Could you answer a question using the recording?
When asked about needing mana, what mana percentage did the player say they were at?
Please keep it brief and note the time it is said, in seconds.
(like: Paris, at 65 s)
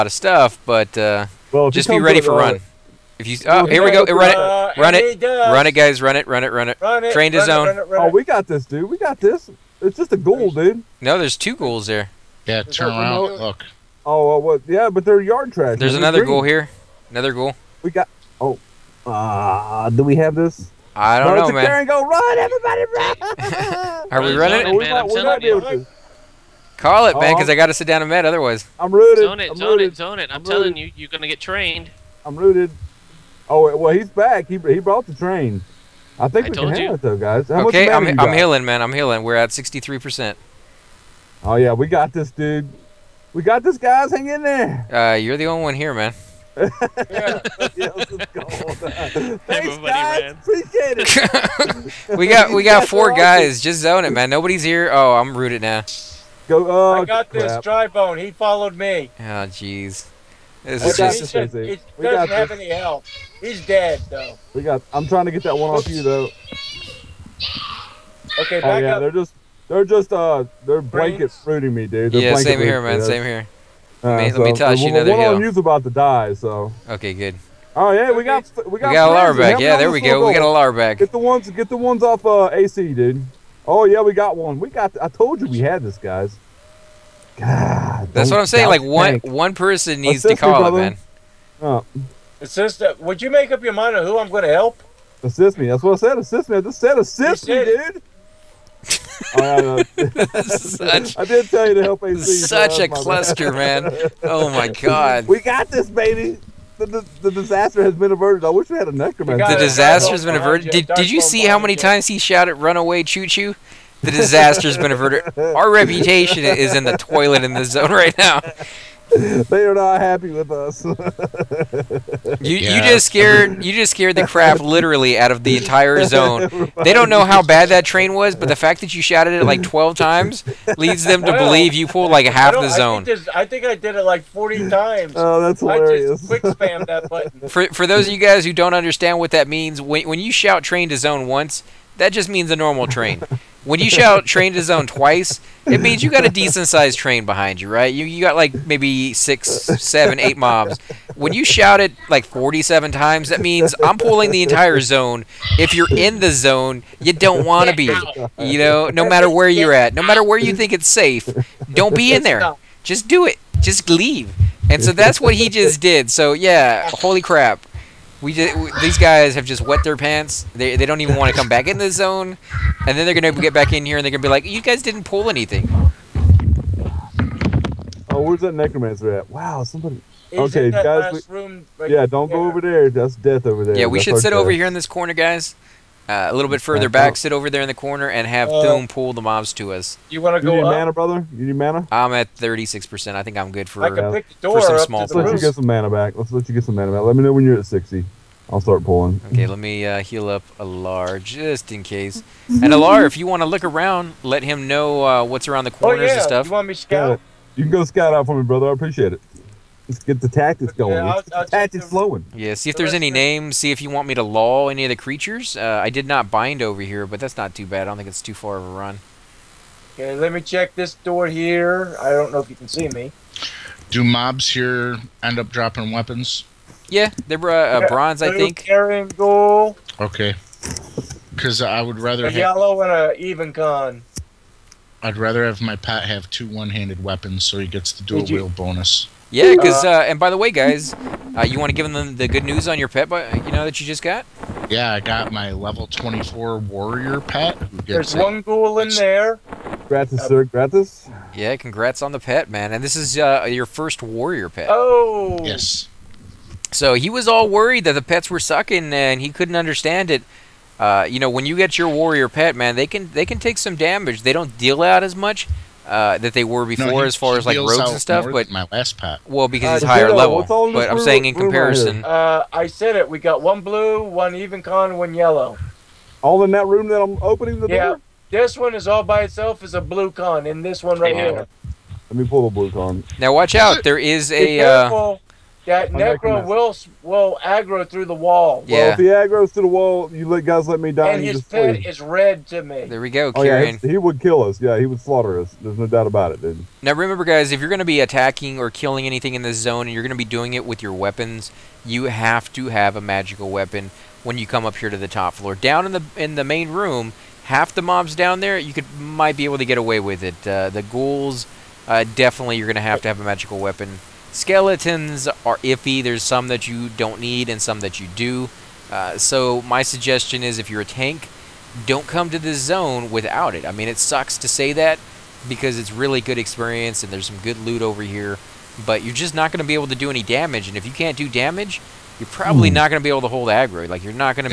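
36%, at 192 s.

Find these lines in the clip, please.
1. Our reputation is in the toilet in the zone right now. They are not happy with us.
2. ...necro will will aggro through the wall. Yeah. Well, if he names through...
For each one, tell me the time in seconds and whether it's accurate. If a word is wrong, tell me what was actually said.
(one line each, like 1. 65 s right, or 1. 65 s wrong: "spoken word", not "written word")
1. 115 s right
2. 285 s wrong: "aggroes", not "names".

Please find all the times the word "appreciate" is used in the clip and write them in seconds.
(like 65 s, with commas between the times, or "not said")
50 s, 208 s.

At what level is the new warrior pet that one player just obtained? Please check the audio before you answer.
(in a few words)
24.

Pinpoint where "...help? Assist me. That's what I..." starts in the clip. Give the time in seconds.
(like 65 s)
94 s.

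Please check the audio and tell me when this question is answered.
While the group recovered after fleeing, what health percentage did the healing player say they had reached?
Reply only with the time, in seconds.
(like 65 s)
39 s.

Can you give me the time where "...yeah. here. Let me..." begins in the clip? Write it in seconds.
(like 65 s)
281 s.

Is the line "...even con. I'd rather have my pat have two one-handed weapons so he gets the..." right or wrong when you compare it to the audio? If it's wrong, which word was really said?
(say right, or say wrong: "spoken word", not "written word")
right.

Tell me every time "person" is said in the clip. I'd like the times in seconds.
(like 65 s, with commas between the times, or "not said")
89 s.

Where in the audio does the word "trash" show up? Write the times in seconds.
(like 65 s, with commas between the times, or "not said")
15 s.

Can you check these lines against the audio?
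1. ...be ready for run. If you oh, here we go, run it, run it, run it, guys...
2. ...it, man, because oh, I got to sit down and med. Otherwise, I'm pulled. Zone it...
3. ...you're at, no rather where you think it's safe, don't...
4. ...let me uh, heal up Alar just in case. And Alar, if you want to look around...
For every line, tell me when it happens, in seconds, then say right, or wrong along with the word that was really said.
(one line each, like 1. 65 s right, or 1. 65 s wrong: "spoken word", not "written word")
1. 1 s right
2. 27 s wrong: "rooted", not "pulled"
3. 159 s wrong: "matter", not "rather"
4. 199 s right.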